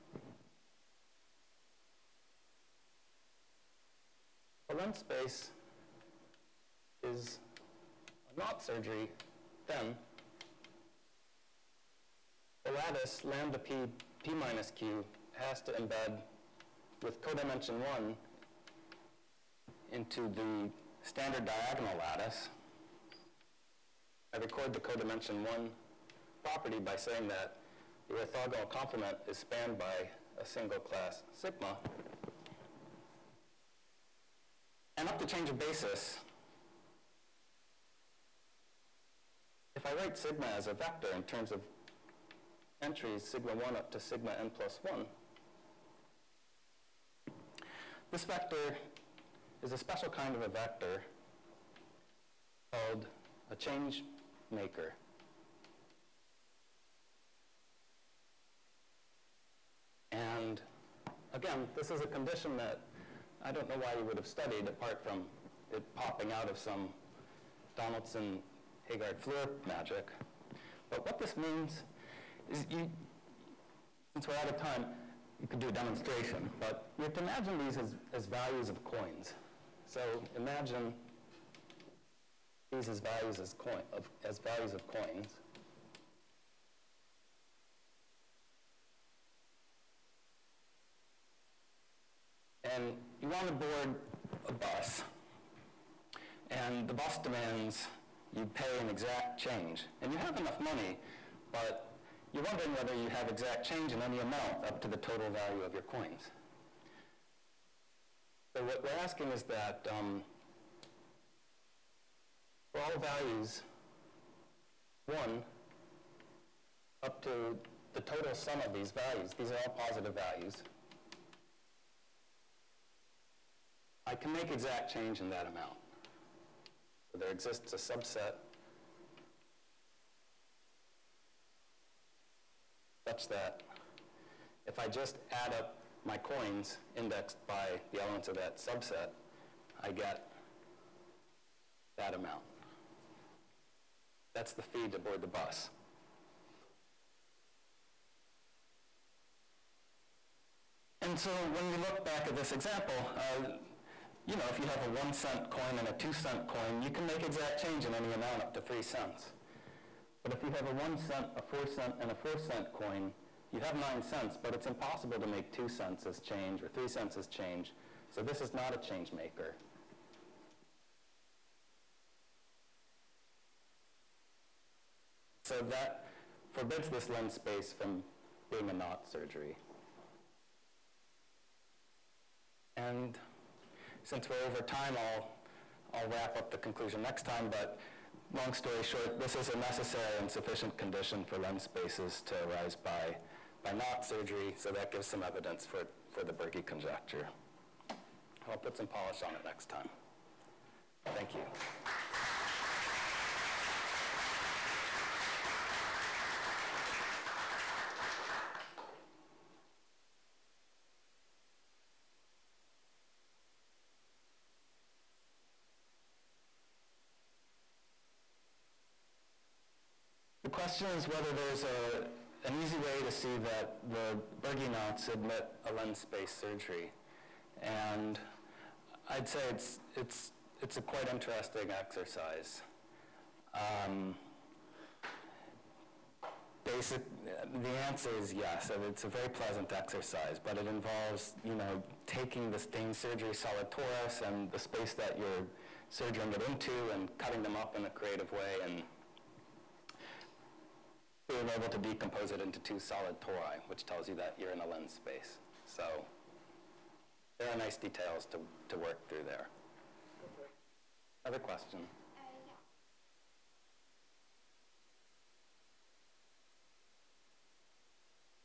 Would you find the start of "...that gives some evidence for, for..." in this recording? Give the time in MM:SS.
03:14.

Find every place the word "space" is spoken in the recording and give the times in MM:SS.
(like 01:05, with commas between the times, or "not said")
00:04, 02:57, 03:11, 03:45, 04:04, 04:14.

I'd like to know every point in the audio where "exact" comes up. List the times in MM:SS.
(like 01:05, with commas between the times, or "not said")
01:38, 01:43, 02:04, 02:37.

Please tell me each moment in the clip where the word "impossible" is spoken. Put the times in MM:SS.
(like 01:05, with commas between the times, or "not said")
02:44.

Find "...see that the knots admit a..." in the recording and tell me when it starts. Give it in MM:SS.
03:43.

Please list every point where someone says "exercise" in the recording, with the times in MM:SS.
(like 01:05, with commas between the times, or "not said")
03:51, 03:59.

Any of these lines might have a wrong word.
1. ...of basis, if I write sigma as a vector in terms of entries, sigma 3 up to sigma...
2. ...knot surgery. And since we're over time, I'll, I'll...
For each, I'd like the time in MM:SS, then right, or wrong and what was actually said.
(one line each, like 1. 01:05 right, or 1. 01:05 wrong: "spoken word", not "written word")
1. 00:35 wrong: "1", not "3"
2. 02:58 right.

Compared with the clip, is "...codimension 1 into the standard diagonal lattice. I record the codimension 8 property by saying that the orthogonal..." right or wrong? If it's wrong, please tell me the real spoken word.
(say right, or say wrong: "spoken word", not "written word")
wrong: "1", not "8".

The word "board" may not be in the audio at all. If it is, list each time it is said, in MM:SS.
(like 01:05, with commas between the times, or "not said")
01:33, 02:24.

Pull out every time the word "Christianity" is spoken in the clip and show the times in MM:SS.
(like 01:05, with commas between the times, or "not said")
not said.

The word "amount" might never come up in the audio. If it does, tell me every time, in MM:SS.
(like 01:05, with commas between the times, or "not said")
01:44, 02:05, 02:22, 02:38.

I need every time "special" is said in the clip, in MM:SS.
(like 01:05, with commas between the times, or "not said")
00:49.